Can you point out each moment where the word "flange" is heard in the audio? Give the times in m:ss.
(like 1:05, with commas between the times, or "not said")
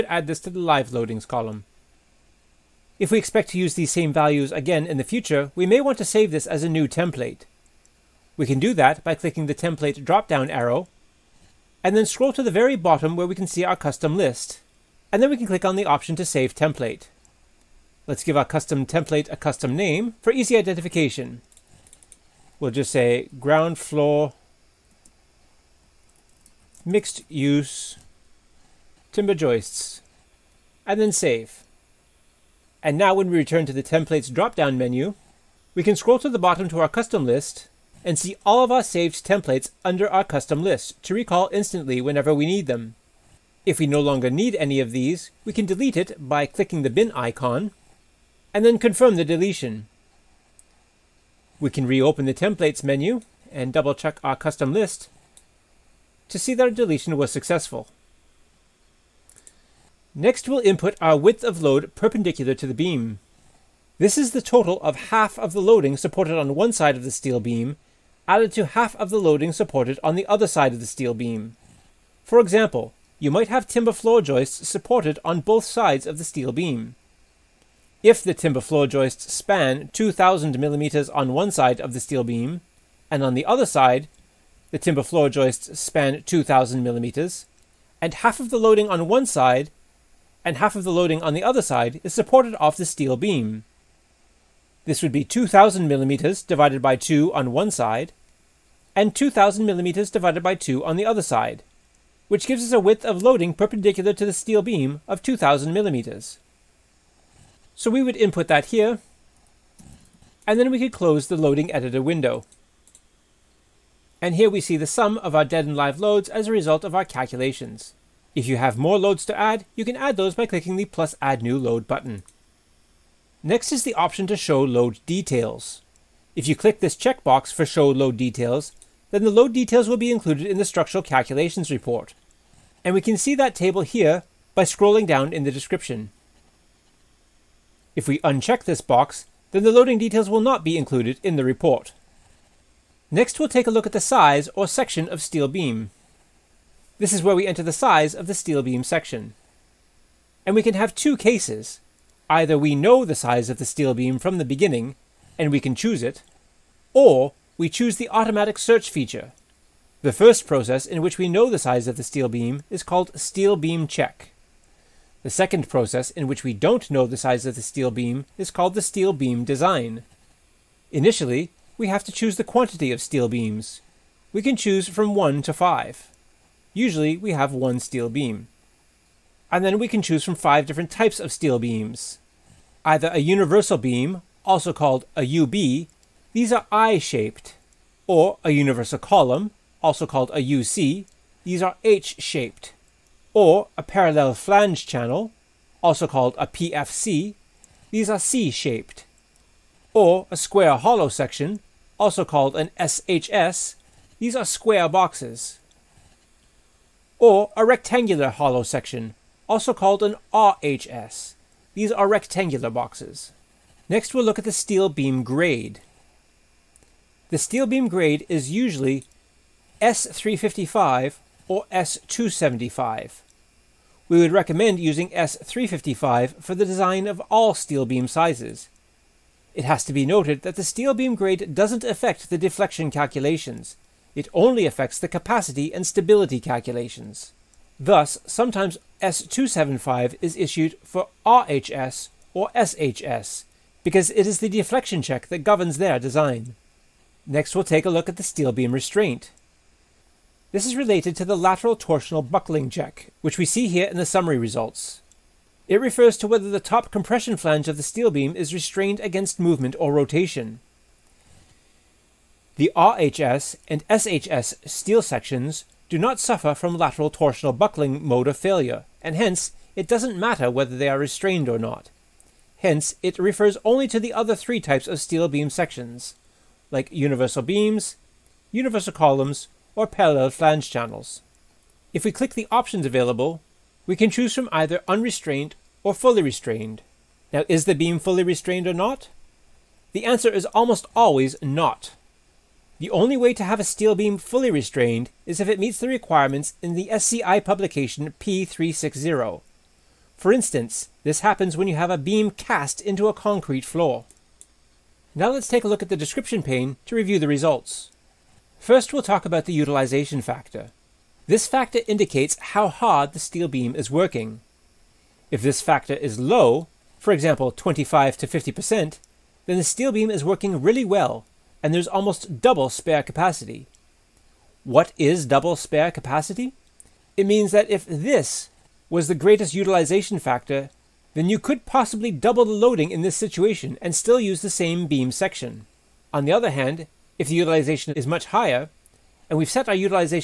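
3:14, 4:17, 4:40.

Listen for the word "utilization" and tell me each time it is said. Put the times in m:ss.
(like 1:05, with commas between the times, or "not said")
5:09, 5:29, 5:37.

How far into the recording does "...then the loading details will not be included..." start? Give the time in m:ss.
2:19.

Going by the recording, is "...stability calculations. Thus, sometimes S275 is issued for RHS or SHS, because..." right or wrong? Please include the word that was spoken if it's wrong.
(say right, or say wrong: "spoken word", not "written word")
right.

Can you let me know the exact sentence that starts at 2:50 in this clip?
Initially, we have to choose the quantity of steel beams.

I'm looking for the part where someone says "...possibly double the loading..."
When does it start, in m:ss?
5:31.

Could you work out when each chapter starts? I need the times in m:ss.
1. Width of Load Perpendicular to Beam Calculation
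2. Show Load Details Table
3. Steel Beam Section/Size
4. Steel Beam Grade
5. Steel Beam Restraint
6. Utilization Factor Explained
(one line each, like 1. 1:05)
1. 1:05
2. 2:10
3. 2:30
4. 3:45
5. 4:15
6. 5:15.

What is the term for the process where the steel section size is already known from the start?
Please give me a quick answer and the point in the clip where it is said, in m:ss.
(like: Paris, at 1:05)
Steel beam check, at 2:43.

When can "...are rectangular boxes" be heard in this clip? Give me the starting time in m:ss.
3:31.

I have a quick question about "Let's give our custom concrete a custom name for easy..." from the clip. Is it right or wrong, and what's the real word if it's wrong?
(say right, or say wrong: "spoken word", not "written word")
wrong: "template", not "concrete".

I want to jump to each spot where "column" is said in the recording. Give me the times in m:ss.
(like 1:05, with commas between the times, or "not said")
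0:01, 3:08, 4:38.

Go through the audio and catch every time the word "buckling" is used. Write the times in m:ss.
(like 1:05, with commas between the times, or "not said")
4:12, 4:27.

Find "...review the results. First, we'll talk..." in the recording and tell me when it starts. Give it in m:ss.
5:06.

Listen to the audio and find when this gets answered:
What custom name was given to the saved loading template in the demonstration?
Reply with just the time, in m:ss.
0:23.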